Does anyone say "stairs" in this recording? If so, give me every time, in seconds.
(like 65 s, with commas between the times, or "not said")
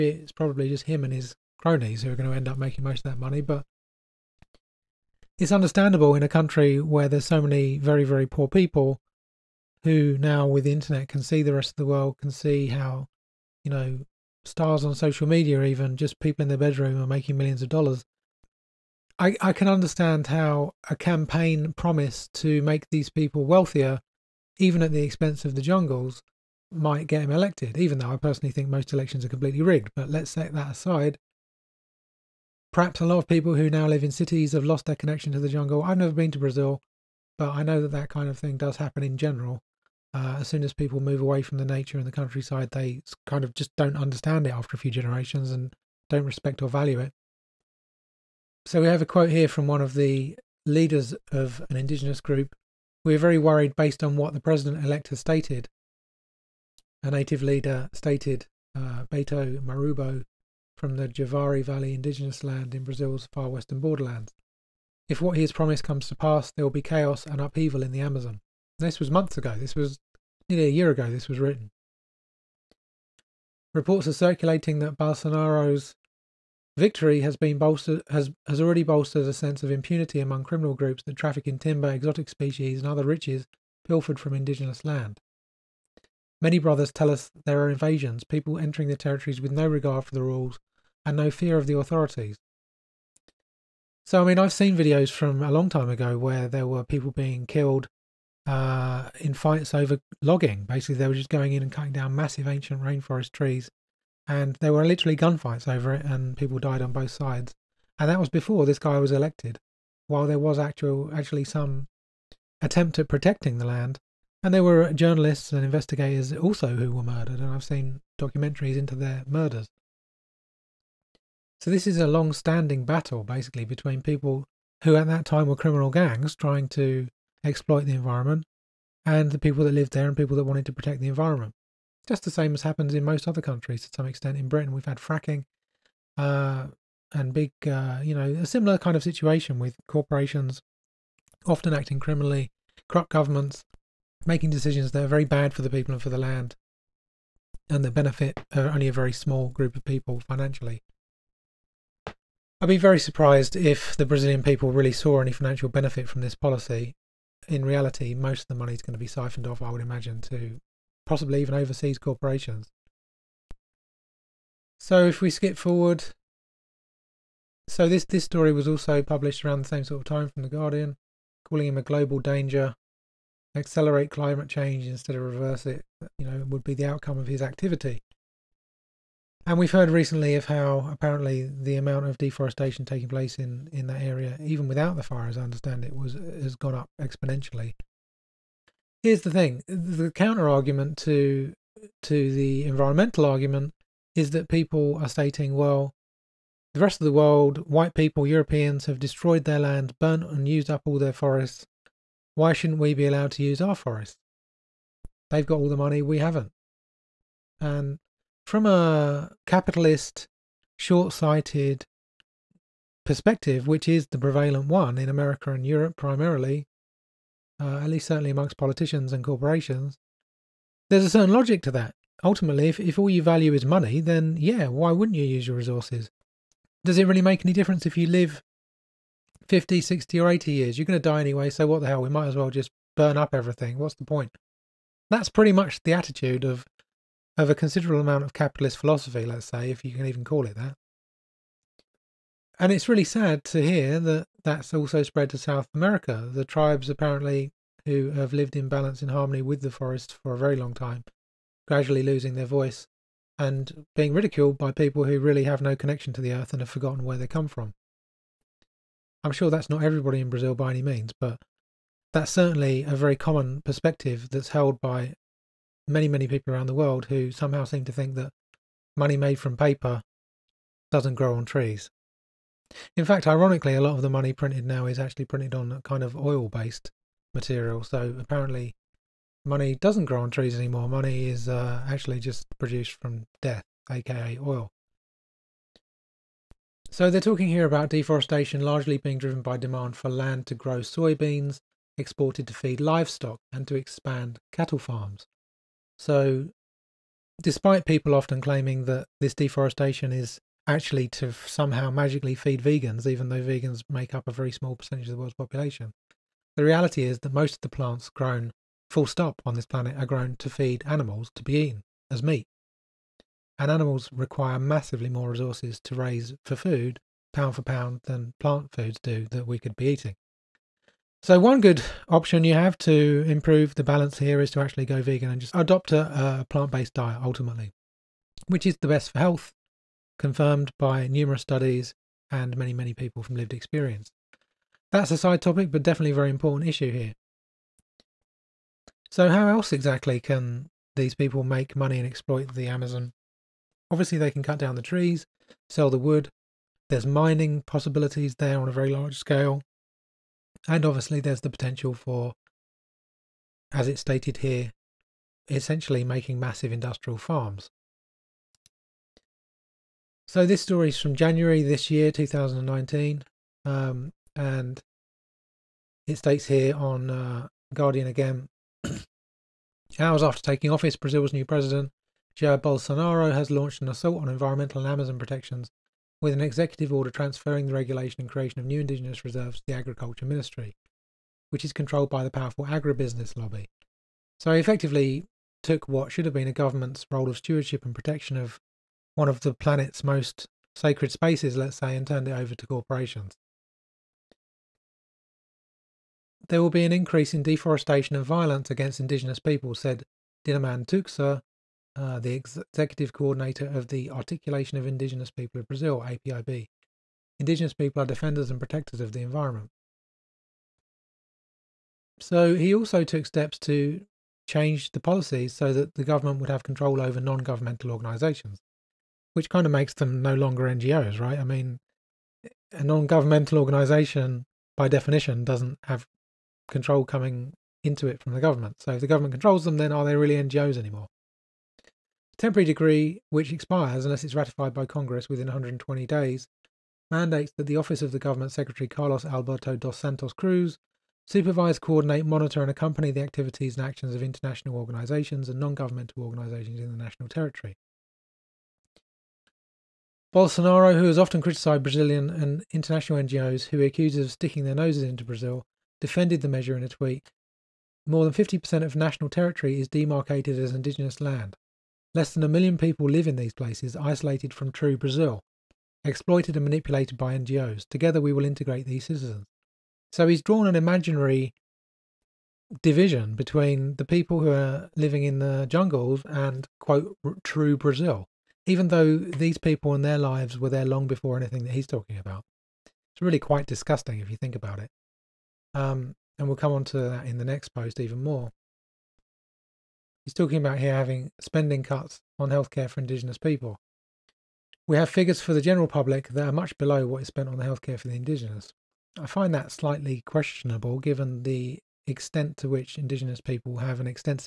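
not said.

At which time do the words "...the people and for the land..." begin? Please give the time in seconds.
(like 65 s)
145 s.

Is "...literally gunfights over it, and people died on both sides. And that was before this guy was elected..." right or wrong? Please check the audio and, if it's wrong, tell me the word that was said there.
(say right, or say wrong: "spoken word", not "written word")
right.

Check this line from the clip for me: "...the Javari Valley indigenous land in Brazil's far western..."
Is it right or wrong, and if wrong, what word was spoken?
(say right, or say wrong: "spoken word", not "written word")
right.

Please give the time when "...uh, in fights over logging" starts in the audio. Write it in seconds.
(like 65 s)
98 s.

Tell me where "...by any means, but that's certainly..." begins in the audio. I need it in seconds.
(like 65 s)
260 s.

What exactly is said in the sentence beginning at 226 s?
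Does it really make any difference if you live 50, 60, or 80 years?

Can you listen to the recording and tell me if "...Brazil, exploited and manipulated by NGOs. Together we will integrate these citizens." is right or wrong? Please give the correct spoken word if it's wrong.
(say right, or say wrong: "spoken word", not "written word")
right.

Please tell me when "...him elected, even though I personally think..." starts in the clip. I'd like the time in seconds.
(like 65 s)
27 s.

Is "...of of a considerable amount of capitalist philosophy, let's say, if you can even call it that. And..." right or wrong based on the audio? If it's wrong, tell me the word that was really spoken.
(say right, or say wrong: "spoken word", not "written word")
right.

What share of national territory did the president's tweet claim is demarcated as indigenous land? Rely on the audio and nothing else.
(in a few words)
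More than 50%.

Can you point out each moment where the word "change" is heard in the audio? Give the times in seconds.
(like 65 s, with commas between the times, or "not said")
174 s, 414 s.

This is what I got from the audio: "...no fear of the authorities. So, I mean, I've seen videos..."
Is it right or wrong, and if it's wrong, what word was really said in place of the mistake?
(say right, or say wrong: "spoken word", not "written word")
right.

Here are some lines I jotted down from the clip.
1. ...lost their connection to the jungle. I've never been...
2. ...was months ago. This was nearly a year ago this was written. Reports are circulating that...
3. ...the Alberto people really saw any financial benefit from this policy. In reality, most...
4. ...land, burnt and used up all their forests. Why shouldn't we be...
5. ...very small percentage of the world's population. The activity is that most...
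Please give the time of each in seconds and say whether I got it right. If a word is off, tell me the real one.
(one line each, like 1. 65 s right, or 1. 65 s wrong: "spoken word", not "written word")
1. 34 s right
2. 68 s right
3. 153 s wrong: "Brazilian", not "Alberto"
4. 199 s right
5. 304 s wrong: "reality", not "activity".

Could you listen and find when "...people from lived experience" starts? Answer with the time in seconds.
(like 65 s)
332 s.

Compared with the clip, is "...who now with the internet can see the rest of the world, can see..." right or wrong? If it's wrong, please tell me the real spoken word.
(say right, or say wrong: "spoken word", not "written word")
right.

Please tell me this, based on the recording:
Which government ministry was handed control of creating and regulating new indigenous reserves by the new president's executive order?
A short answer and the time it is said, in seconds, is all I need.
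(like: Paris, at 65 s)
Agriculture Ministry, at 379 s.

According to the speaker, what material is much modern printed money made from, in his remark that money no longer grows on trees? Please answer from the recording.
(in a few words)
oil-based material.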